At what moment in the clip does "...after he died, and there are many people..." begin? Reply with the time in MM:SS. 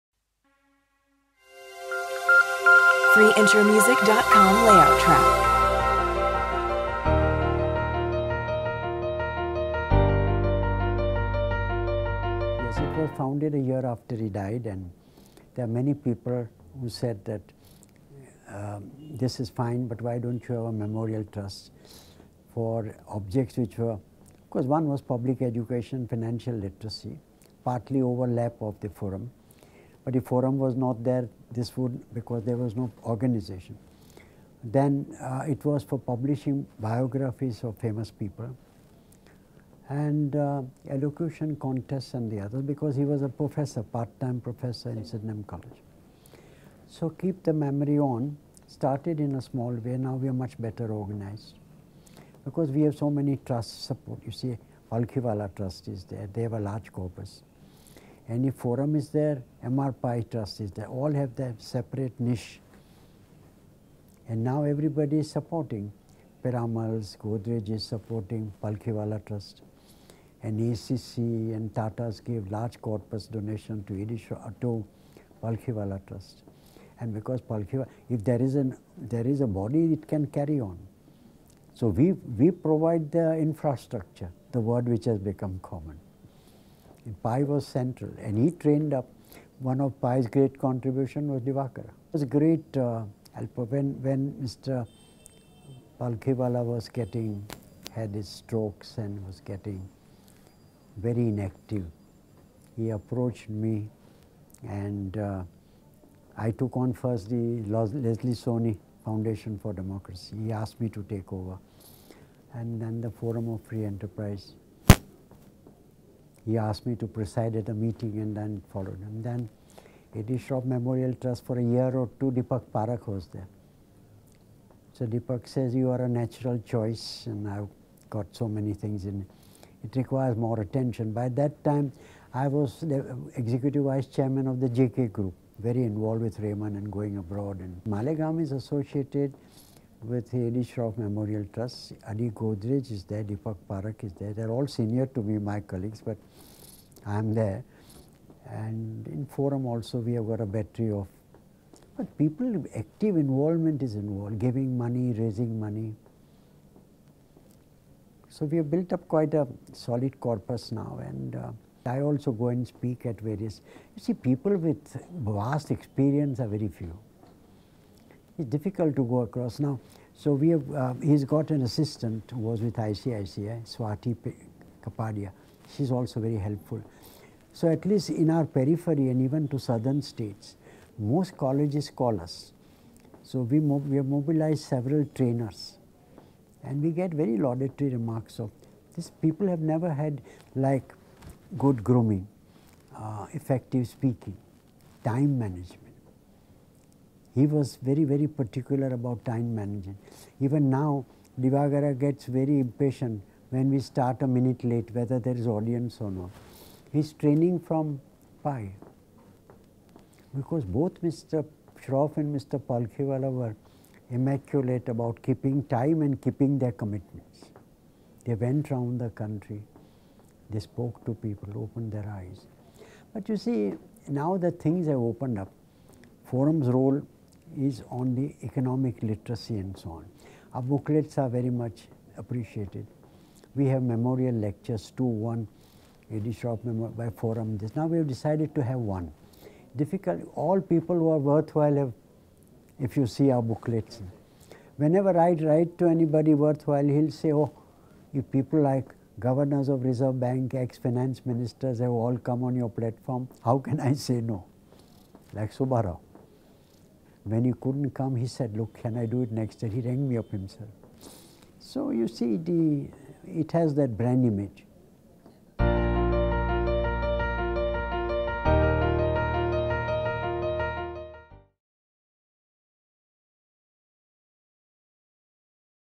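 00:13.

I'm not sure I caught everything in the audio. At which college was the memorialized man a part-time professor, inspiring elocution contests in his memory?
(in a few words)
Sydenham College.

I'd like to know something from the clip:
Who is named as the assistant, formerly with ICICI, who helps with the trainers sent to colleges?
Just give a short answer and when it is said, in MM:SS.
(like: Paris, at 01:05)
Swati Kapadia, at 02:53.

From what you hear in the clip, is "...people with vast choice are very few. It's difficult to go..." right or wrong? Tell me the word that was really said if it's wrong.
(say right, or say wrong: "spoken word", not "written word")
wrong: "experience", not "choice".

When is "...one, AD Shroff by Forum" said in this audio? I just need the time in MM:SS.
03:55.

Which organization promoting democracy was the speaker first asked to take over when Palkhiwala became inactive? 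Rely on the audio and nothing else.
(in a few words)
Leslie Sawhny Foundation for Democracy.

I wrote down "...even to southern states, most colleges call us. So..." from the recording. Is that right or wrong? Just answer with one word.
right.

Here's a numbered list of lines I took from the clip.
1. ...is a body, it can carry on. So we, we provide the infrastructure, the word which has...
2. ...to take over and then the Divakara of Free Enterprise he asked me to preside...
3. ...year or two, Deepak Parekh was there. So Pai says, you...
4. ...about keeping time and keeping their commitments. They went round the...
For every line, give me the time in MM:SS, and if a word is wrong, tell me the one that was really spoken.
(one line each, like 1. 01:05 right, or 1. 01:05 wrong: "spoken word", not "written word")
1. 01:19 right
2. 01:50 wrong: "Forum", not "Divakara"
3. 02:01 wrong: "Deepak", not "Pai"
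4. 03:34 right.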